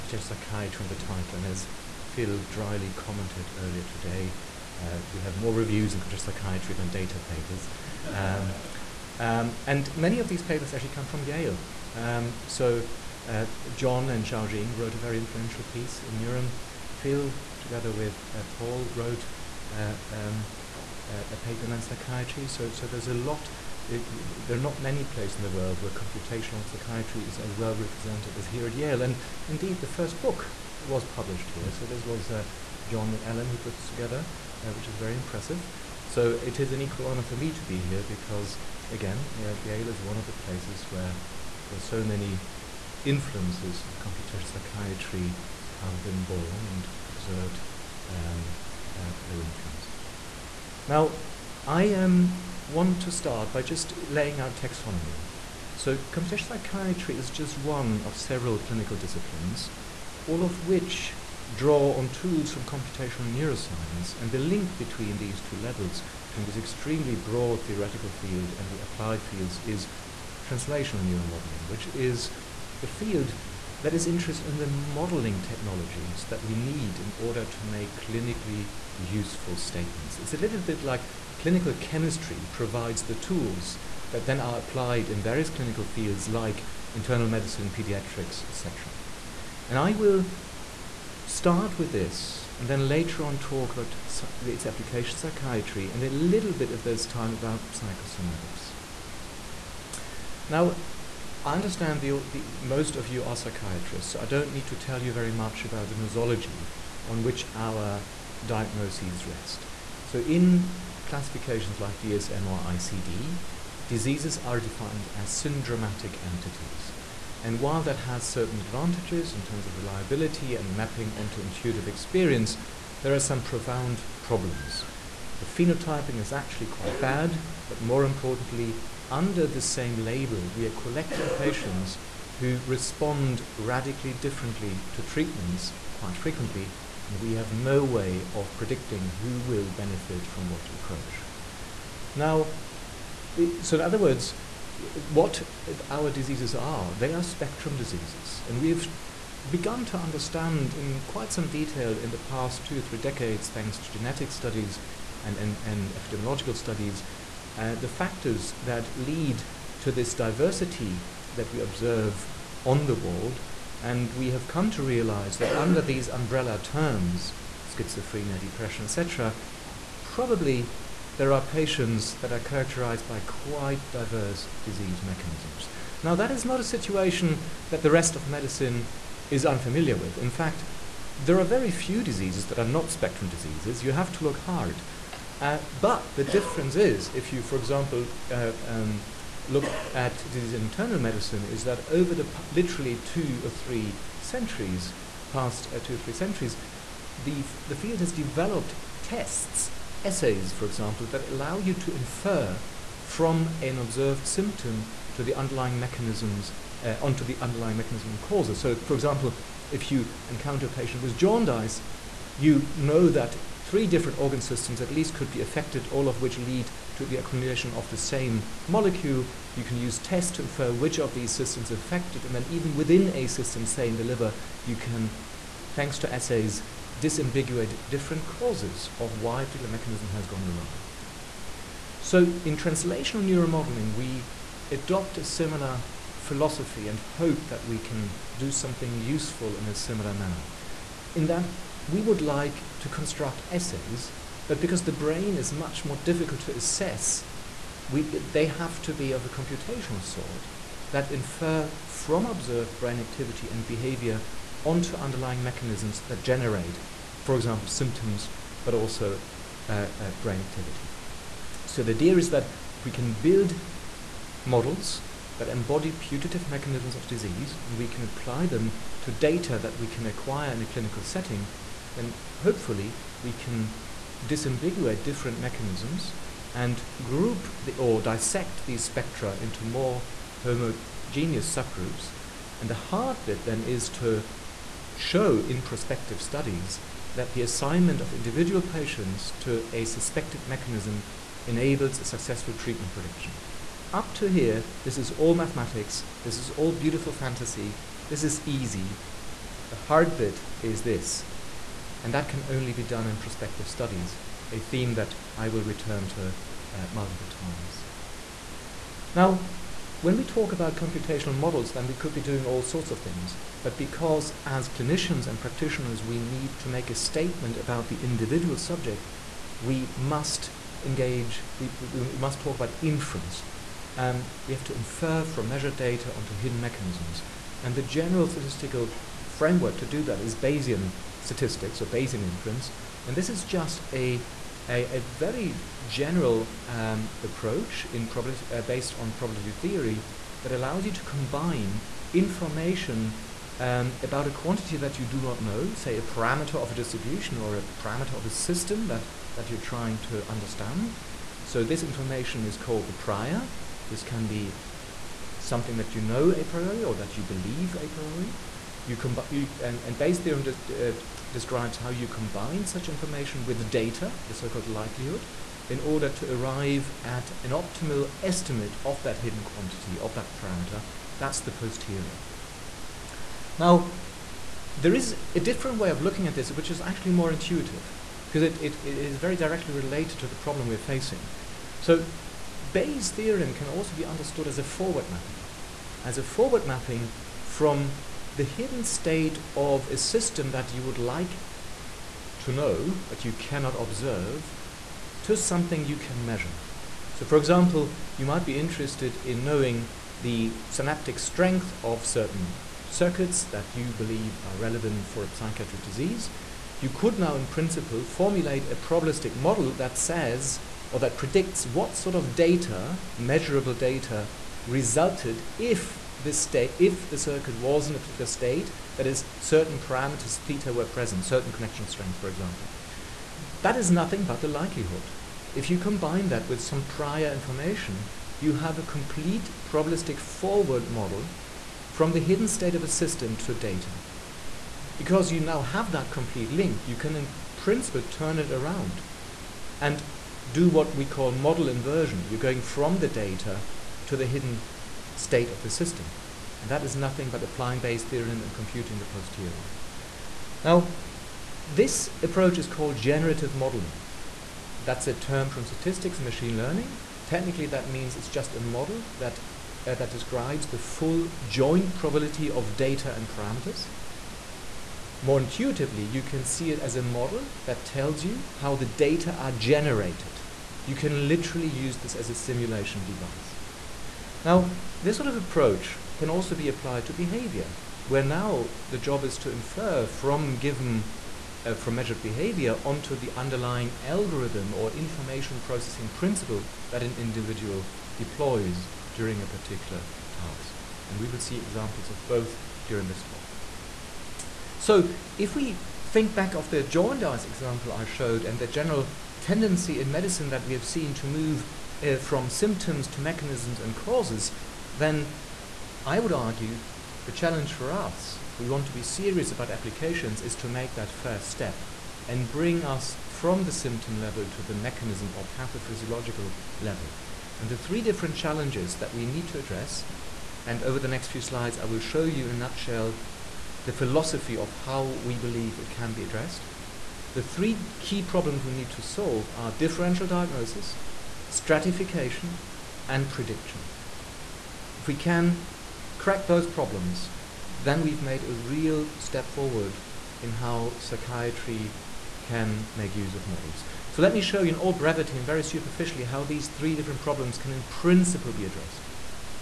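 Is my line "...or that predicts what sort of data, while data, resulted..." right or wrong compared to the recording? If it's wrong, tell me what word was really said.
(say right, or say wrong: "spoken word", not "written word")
wrong: "measurable", not "while".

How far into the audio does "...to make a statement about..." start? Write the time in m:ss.
5:16.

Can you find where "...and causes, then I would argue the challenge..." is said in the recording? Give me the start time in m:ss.
8:23.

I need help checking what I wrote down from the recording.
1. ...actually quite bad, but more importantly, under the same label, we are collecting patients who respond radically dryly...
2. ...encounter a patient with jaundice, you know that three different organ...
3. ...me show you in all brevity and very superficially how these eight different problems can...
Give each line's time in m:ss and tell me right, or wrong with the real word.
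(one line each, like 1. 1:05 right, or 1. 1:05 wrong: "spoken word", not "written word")
1. 2:06 wrong: "differently", not "dryly"
2. 3:30 right
3. 9:04 wrong: "three", not "eight".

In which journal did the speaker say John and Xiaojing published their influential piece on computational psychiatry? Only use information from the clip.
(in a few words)
Neuron.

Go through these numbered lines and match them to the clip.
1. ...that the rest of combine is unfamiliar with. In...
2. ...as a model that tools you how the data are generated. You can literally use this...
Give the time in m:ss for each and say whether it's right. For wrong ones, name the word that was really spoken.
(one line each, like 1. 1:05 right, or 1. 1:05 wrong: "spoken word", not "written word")
1. 2:57 wrong: "medicine", not "combine"
2. 7:46 wrong: "tells", not "tools".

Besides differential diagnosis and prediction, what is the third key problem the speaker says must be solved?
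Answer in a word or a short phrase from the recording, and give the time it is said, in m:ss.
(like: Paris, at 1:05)
Stratification, at 8:51.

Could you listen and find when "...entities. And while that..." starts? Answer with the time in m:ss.
1:56.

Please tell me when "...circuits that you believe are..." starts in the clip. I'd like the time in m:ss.
6:42.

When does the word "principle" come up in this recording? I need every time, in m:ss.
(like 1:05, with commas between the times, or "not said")
6:47, 7:17, 8:06, 9:07.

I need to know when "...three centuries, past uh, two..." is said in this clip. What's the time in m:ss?
3:13.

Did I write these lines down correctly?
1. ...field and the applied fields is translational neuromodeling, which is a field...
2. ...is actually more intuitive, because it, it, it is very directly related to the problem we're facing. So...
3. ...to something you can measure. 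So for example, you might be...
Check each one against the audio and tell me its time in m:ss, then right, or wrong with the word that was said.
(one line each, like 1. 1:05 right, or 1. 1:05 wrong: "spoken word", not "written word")
1. 1:08 right
2. 6:16 right
3. 6:35 right.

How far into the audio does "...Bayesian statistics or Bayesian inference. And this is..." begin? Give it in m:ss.
5:30.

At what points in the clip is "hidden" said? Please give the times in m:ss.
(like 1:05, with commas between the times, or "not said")
5:26, 6:09, 6:28, 7:12, 7:24.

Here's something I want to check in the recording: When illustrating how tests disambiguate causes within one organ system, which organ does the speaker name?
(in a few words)
The liver.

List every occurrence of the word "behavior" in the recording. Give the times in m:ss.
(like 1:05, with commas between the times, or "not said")
4:13, 7:57, 8:02.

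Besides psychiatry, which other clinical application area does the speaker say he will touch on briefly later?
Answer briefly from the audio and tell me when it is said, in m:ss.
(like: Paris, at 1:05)
Psychosomatics, at 1:37.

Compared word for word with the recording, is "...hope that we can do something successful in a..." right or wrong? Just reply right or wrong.
wrong.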